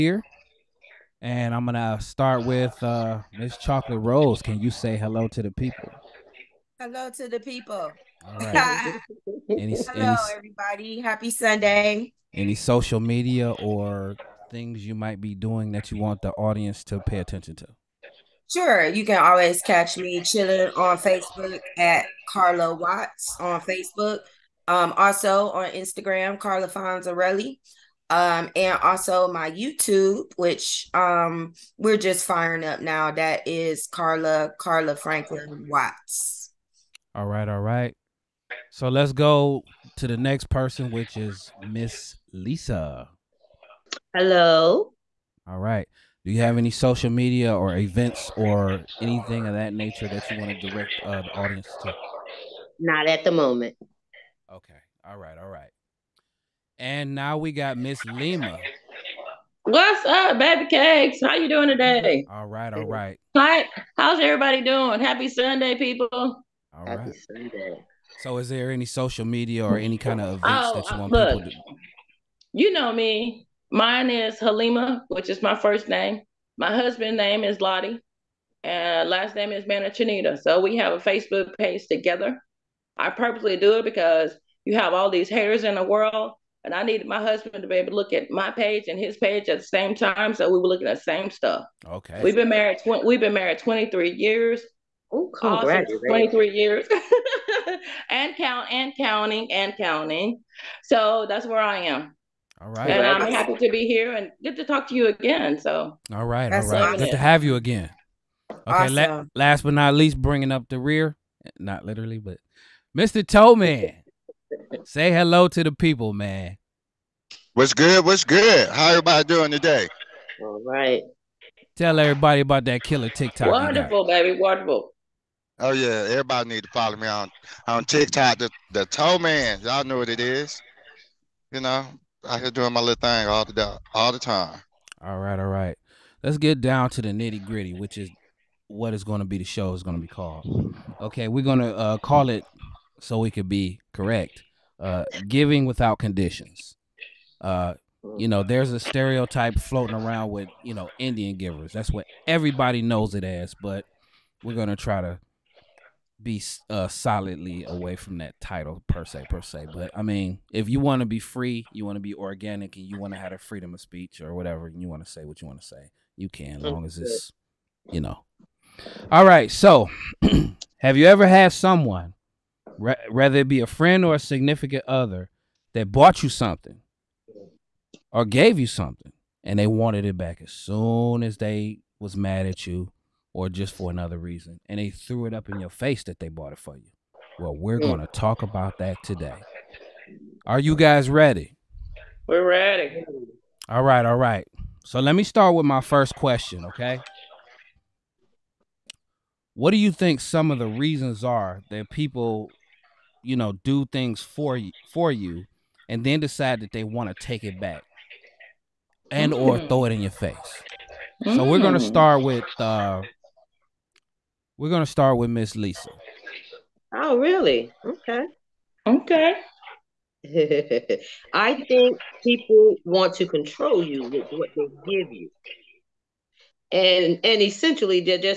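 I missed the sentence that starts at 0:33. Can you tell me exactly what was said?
That is Carla, Carla Franklin Watts.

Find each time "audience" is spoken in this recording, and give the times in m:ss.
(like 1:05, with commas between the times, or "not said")
0:16, 0:51.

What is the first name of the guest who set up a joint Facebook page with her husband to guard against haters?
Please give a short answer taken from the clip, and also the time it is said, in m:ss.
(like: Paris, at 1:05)
Lottie, at 1:17.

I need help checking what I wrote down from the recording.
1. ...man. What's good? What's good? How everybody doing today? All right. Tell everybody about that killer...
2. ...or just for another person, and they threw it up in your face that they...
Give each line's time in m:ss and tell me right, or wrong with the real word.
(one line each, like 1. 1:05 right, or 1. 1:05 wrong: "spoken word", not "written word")
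1. 1:56 right
2. 3:03 wrong: "reason", not "person".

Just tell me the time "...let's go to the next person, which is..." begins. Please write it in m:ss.
0:38.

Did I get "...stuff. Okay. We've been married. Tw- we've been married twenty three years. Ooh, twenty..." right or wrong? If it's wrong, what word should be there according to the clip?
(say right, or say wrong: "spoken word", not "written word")
right.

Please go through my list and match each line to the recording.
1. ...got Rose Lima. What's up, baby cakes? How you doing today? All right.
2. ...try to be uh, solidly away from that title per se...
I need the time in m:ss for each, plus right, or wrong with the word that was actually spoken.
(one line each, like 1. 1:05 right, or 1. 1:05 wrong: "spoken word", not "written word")
1. 0:57 wrong: "Miss", not "Rose"
2. 2:34 right.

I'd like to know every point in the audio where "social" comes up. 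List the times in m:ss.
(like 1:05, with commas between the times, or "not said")
0:12, 0:46, 1:08.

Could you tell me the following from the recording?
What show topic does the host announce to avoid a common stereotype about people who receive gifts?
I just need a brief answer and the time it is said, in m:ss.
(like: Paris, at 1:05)
Giving without conditions, at 2:25.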